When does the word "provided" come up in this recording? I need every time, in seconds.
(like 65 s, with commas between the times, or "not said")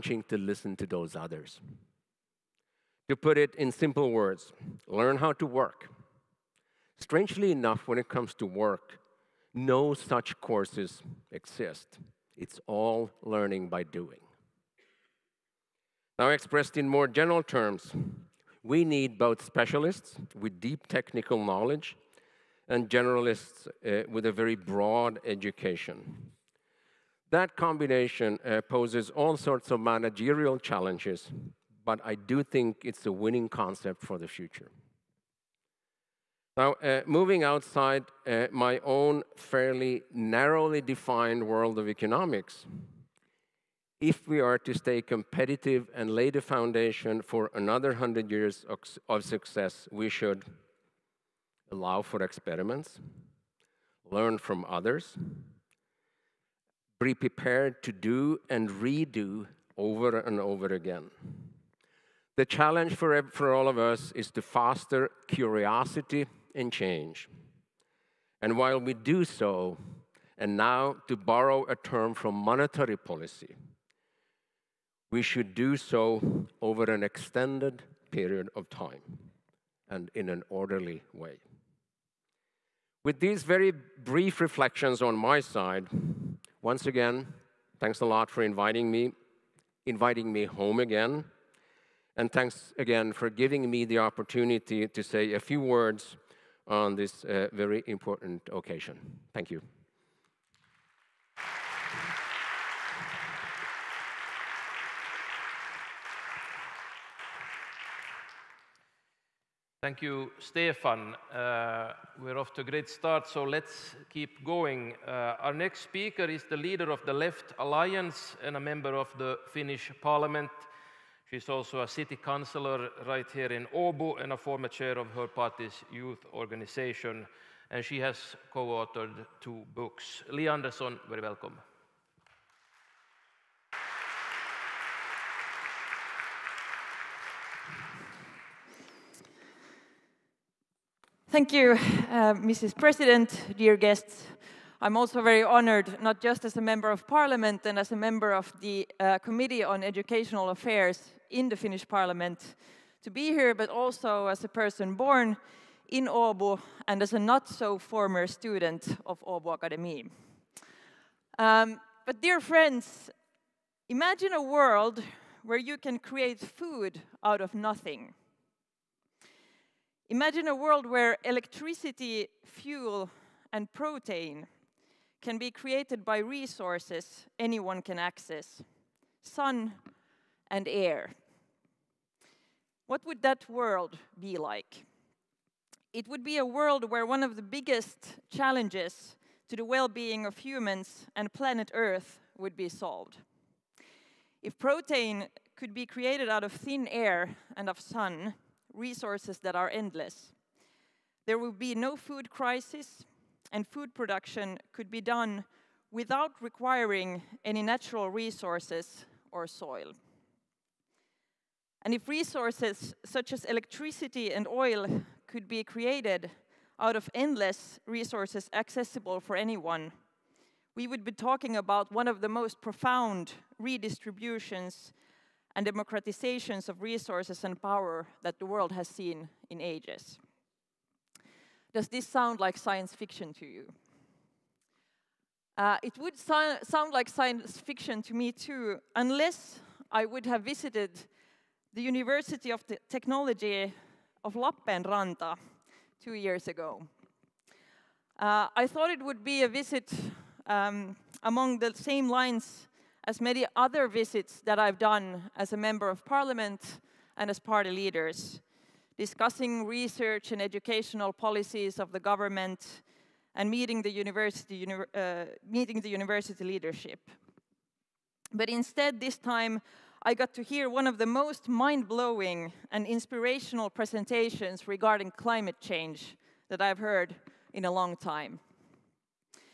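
not said.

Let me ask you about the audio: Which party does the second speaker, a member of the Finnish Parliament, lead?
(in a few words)
Left Alliance.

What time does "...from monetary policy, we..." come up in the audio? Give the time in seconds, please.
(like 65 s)
72 s.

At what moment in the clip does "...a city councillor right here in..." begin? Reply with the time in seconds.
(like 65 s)
121 s.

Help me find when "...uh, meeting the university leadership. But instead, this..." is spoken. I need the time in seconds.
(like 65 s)
264 s.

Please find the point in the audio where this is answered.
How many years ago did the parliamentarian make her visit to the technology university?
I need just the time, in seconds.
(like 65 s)
246 s.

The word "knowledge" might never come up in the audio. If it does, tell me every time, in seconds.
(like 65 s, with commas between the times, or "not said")
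21 s.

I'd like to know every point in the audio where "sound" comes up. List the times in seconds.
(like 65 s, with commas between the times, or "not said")
232 s, 236 s.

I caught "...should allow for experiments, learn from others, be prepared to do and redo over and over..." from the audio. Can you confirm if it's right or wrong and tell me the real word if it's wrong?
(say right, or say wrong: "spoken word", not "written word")
right.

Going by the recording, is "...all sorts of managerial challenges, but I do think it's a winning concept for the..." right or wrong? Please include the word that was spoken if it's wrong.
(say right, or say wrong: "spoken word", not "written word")
right.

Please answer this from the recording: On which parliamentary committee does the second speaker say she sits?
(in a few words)
Committee on Educational Affairs.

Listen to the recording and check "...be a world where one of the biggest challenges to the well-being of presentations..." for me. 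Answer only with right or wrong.
wrong.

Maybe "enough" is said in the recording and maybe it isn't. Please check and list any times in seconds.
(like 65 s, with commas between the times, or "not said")
7 s.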